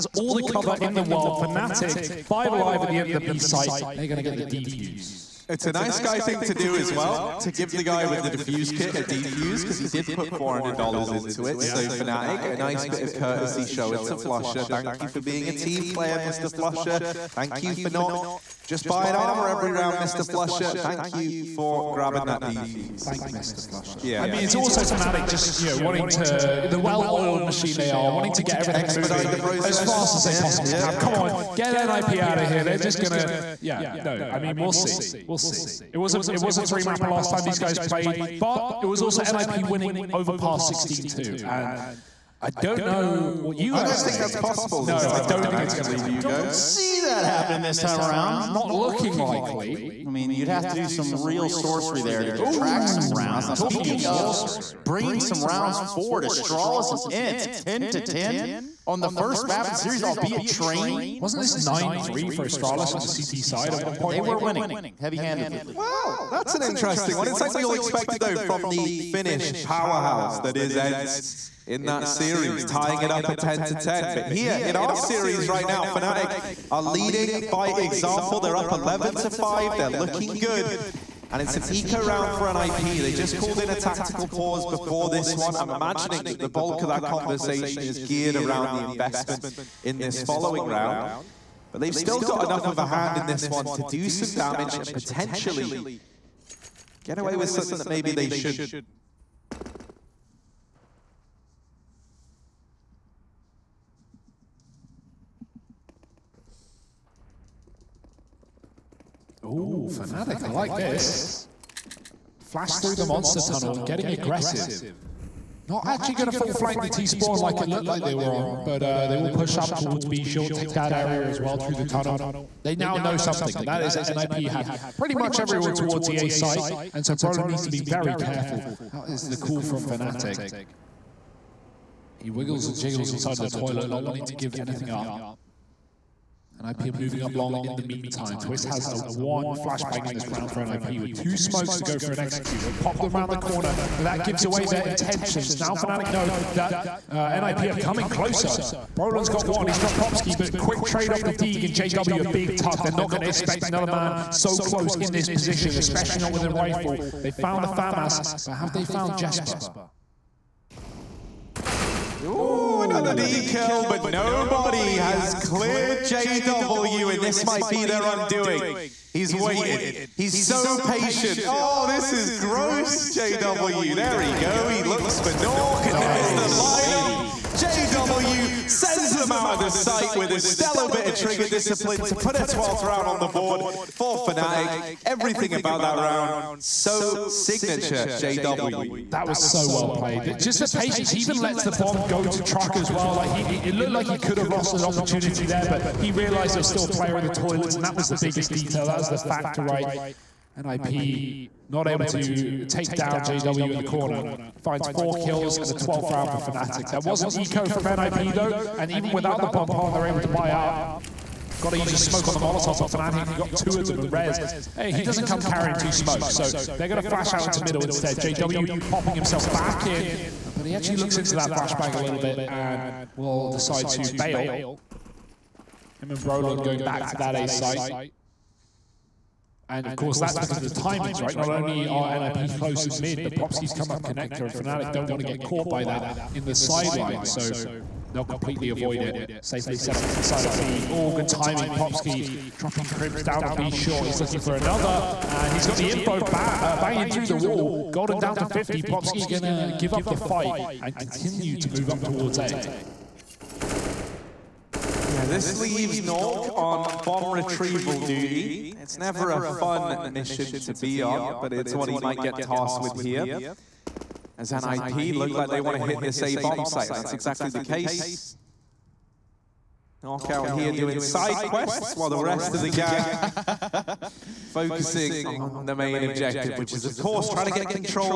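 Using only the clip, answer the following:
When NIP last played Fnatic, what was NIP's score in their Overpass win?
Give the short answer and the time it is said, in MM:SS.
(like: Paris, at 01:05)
16-2, at 00:40.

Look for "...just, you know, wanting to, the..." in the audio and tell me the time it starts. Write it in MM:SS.
00:25.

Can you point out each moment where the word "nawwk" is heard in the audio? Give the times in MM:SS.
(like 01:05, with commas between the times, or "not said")
02:55, 04:16.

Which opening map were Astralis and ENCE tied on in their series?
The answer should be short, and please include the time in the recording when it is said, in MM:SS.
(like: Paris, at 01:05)
Train, at 01:00.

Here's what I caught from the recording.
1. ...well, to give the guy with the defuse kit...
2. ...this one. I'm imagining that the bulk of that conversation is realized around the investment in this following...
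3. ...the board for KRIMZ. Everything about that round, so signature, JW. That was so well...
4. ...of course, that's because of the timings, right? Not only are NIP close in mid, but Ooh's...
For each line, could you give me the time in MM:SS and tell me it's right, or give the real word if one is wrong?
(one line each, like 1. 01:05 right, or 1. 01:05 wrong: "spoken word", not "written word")
1. 00:06 right
2. 01:25 wrong: "geared", not "realized"
3. 03:03 wrong: "Fnatic", not "KRIMZ"
4. 03:49 wrong: "Plopski", not "Ooh".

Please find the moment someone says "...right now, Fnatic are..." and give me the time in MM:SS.
01:15.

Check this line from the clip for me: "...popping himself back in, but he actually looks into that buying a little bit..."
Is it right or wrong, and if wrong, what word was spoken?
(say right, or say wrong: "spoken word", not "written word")
wrong: "flashbang", not "buying".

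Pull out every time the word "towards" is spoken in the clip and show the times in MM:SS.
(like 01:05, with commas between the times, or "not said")
01:59, 02:05, 04:12.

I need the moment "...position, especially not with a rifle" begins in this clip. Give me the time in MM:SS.
02:35.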